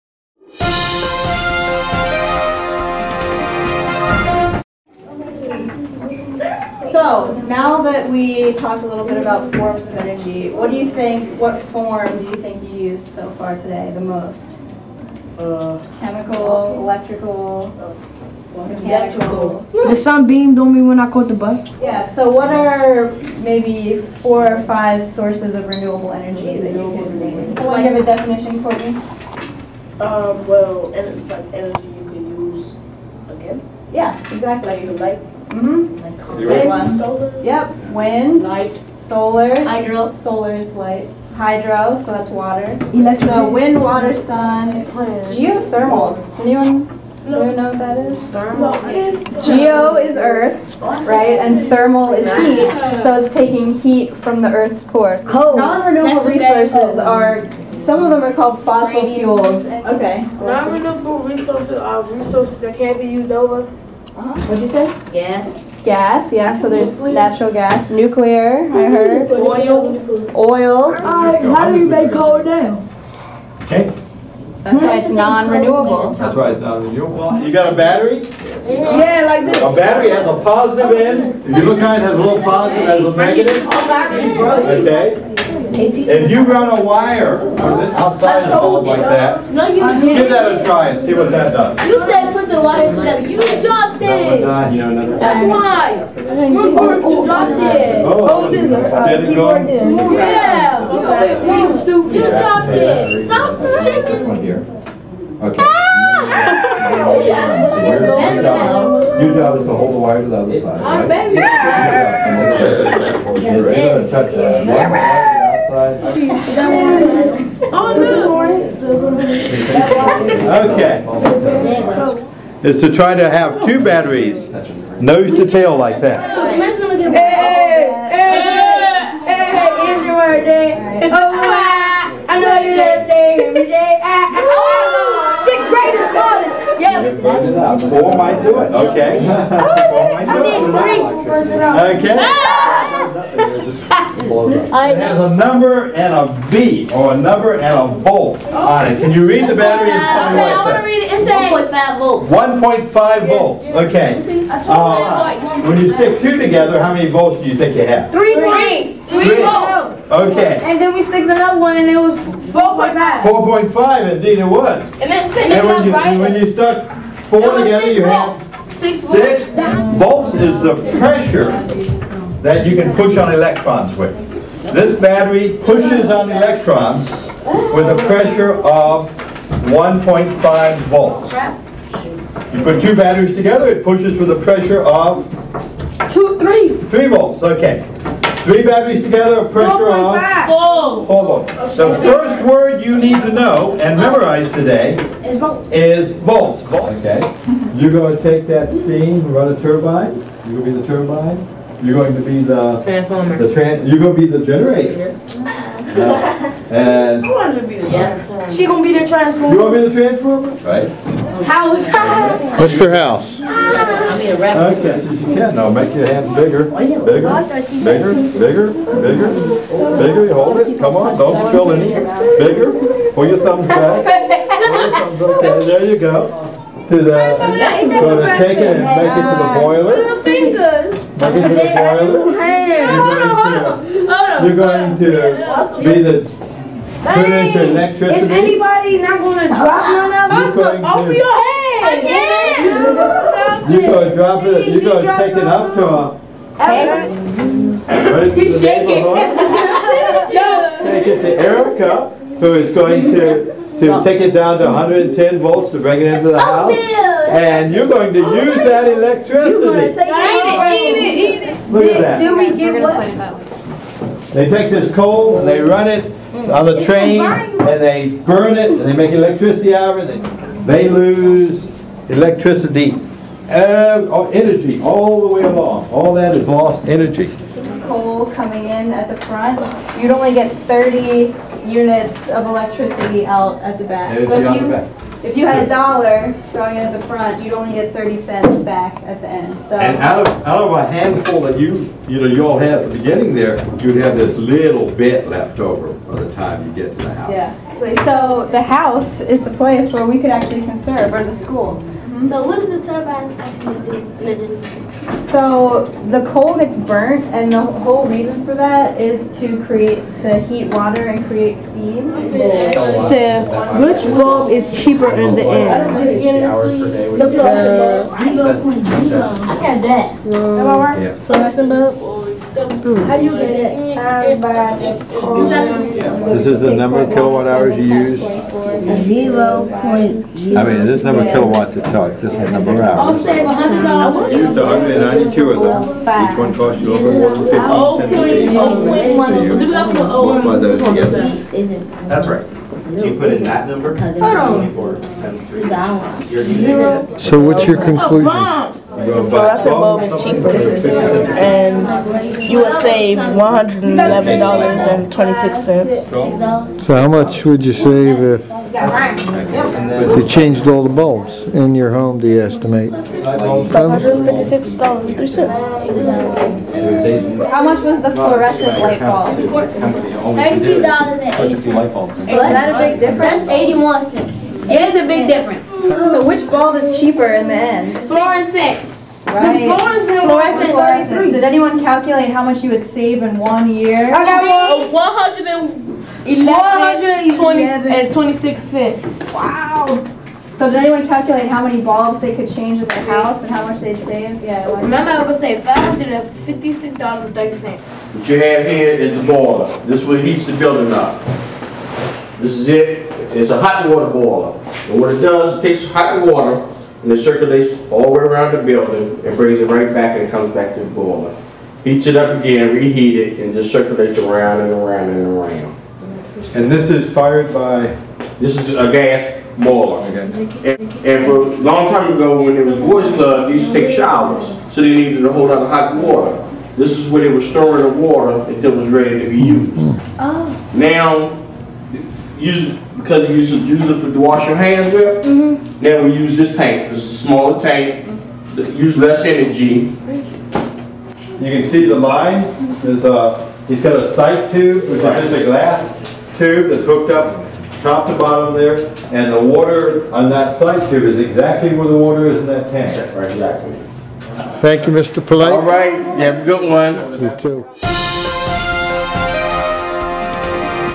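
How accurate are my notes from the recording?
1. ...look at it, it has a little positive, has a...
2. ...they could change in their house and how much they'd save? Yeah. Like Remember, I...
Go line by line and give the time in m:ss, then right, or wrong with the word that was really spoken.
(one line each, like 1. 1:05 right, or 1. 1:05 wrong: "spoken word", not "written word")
1. 1:21 right
2. 6:32 right.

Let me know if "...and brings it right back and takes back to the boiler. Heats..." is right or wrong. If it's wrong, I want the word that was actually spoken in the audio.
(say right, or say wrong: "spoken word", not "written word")
wrong: "comes", not "takes".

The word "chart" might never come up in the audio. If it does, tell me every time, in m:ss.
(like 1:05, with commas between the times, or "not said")
not said.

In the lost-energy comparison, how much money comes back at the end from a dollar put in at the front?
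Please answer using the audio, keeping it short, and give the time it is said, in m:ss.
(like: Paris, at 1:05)
30 cents, at 4:47.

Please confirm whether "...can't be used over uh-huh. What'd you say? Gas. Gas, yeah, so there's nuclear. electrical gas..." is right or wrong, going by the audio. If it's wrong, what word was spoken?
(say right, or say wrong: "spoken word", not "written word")
wrong: "natural", not "electrical".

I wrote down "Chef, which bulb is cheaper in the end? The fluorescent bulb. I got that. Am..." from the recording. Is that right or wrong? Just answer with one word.
right.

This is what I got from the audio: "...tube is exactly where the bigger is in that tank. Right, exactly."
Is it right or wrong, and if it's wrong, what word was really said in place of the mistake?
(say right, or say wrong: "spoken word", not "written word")
wrong: "water", not "bigger".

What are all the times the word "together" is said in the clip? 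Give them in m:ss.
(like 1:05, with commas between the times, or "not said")
1:32, 2:36, 2:47, 3:03, 3:09, 5:40.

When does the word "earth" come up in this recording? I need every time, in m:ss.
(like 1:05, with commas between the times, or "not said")
0:50, 0:54.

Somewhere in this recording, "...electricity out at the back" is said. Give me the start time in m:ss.
4:42.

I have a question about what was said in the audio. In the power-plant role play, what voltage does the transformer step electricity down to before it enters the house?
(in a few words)
110 volts.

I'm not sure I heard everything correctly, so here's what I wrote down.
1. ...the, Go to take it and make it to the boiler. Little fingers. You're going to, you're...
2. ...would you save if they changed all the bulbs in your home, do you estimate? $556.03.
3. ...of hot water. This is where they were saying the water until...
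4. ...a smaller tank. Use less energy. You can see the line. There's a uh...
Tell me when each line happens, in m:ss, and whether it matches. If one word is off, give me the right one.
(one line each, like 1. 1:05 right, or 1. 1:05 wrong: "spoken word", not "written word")
1. 3:47 right
2. 5:57 right
3. 7:05 wrong: "storing", not "saying"
4. 7:17 right.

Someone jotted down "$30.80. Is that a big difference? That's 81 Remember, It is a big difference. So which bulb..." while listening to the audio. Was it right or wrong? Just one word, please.
wrong.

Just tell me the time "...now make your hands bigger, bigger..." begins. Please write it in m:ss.
3:35.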